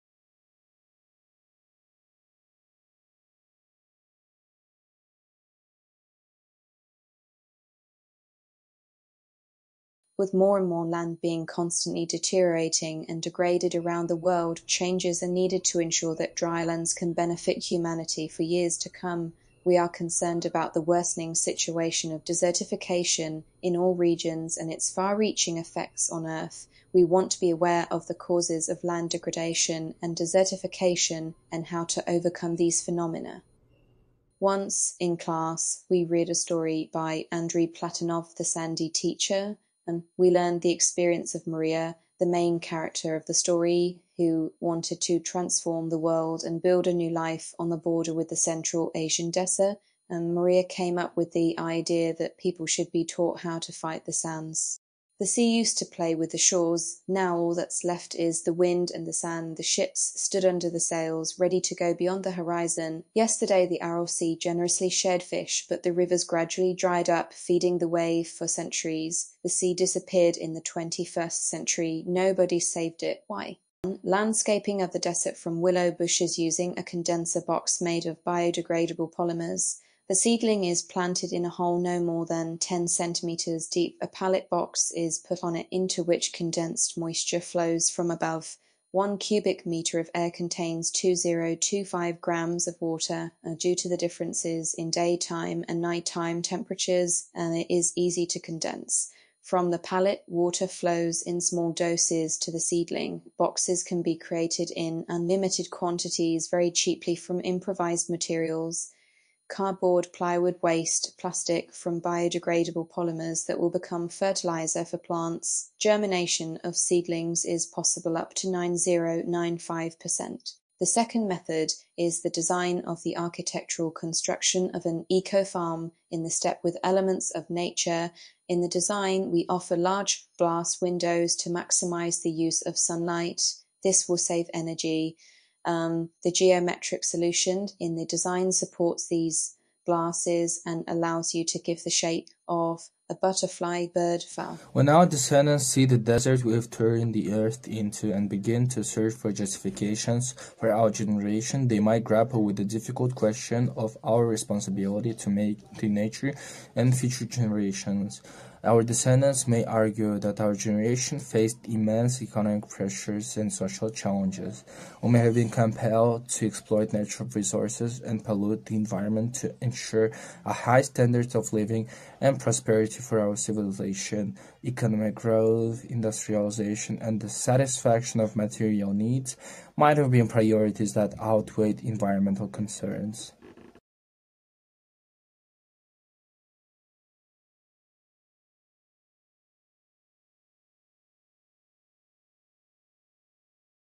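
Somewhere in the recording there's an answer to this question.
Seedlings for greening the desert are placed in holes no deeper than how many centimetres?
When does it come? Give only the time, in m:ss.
1:22.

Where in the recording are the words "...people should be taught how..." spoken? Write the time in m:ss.
0:52.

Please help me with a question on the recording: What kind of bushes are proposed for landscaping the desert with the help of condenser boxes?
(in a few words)
willow.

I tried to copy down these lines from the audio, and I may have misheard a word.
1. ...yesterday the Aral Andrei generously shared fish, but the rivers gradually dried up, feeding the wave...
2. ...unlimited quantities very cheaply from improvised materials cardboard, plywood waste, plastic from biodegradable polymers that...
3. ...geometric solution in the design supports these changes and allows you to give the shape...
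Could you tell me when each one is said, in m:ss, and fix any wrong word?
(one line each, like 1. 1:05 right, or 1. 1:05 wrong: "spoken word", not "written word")
1. 1:03 wrong: "Sea", not "Andrei"
2. 1:45 right
3. 2:16 wrong: "glasses", not "changes".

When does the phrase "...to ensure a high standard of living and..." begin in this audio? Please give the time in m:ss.
2:49.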